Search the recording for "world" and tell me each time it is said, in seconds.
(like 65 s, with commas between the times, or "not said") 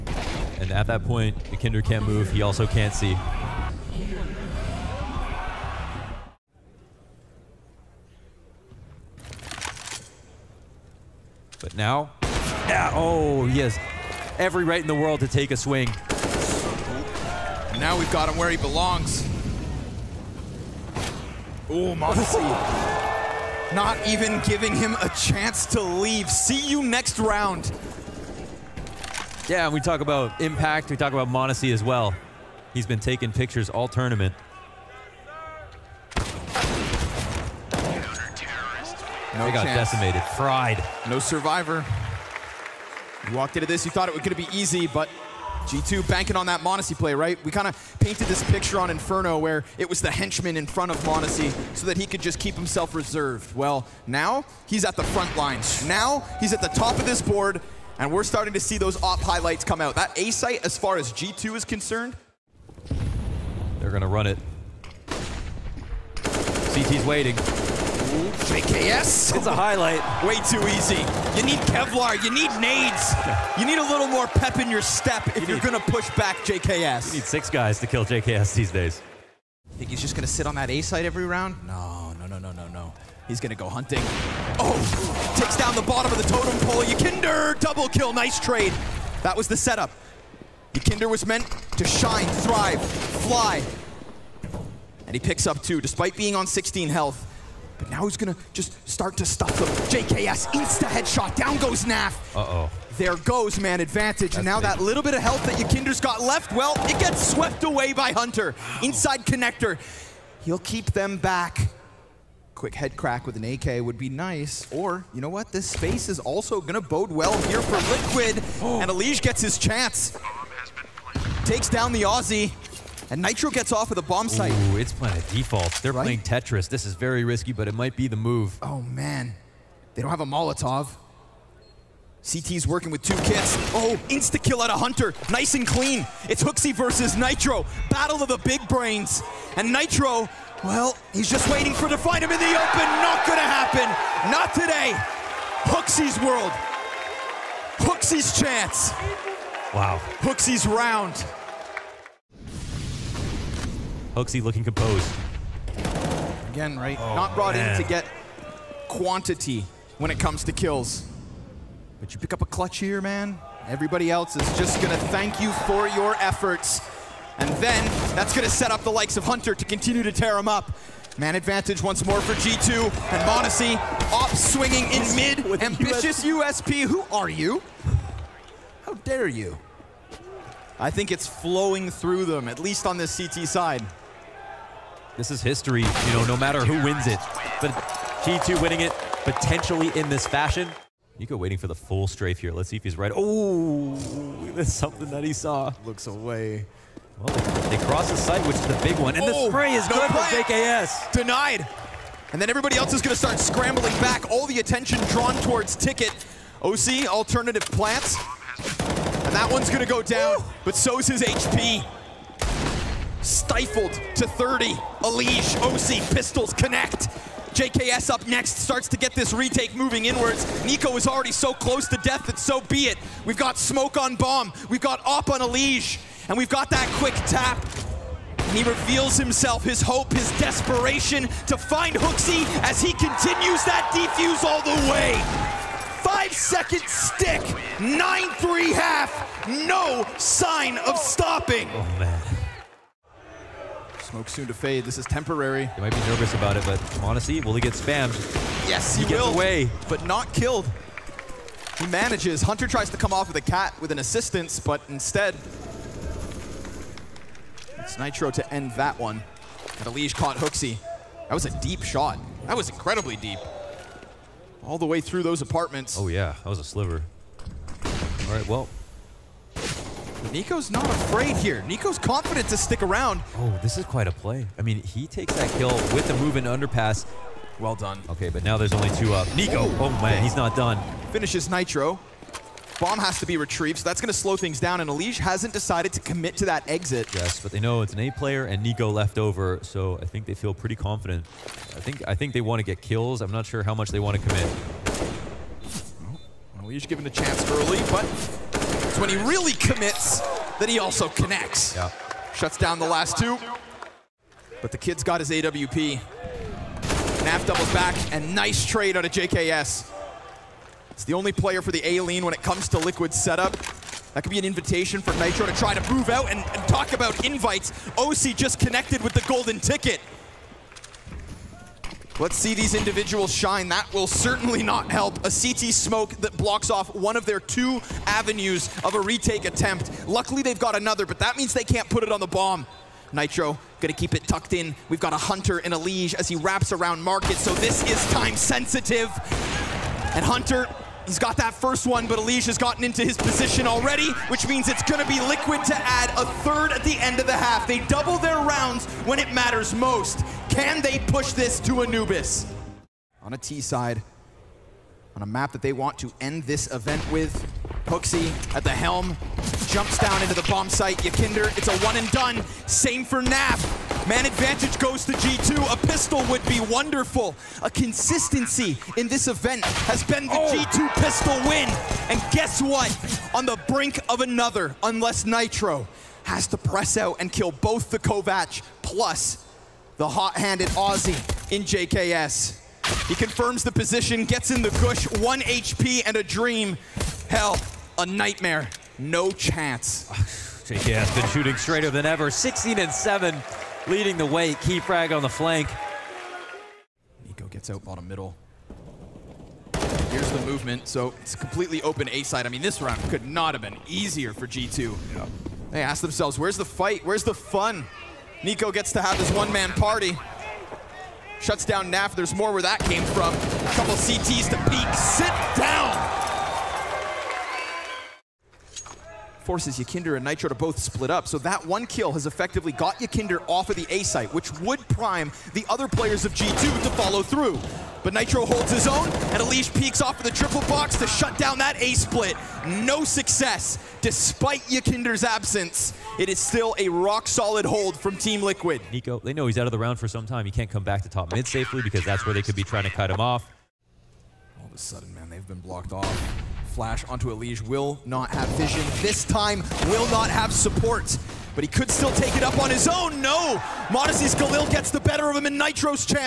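14 s, 146 s.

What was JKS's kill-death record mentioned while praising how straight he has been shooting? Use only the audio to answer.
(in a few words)
16 and 7.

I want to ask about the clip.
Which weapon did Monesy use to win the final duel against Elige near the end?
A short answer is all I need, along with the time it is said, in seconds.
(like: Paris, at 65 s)
Galil, at 454 s.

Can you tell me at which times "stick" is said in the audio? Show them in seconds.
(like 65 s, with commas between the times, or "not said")
236 s, 272 s.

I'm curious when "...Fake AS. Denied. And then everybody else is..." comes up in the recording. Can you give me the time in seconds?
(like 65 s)
200 s.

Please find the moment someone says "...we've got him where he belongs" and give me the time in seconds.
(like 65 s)
17 s.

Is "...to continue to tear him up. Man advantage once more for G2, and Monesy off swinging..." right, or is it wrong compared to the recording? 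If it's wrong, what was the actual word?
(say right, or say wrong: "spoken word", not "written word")
right.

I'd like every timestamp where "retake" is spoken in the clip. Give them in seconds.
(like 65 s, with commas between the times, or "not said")
219 s, 329 s.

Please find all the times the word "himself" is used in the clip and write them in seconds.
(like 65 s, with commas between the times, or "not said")
52 s, 229 s.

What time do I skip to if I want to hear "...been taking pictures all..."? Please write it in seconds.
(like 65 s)
32 s.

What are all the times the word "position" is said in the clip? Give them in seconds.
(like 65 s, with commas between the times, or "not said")
343 s, 383 s.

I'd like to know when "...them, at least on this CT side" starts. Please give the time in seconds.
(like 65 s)
182 s.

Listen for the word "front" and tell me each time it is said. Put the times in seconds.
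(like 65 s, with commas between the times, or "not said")
50 s, 55 s.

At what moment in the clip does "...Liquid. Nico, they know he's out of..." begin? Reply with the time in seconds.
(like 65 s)
438 s.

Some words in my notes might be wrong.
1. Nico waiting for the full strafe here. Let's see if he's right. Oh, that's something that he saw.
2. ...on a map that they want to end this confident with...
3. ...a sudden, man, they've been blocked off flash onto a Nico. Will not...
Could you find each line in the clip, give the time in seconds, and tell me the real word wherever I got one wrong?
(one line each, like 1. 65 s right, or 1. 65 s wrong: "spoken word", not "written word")
1. 191 s right
2. 355 s wrong: "event", not "confident"
3. 444 s wrong: "Elige", not "Nico".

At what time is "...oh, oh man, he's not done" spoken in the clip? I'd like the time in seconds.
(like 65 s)
279 s.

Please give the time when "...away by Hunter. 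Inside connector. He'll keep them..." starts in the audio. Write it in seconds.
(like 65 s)
107 s.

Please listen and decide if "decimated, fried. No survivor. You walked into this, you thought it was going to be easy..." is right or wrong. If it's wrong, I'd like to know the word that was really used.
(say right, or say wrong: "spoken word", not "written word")
right.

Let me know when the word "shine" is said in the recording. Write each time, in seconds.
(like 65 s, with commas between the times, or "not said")
91 s, 323 s.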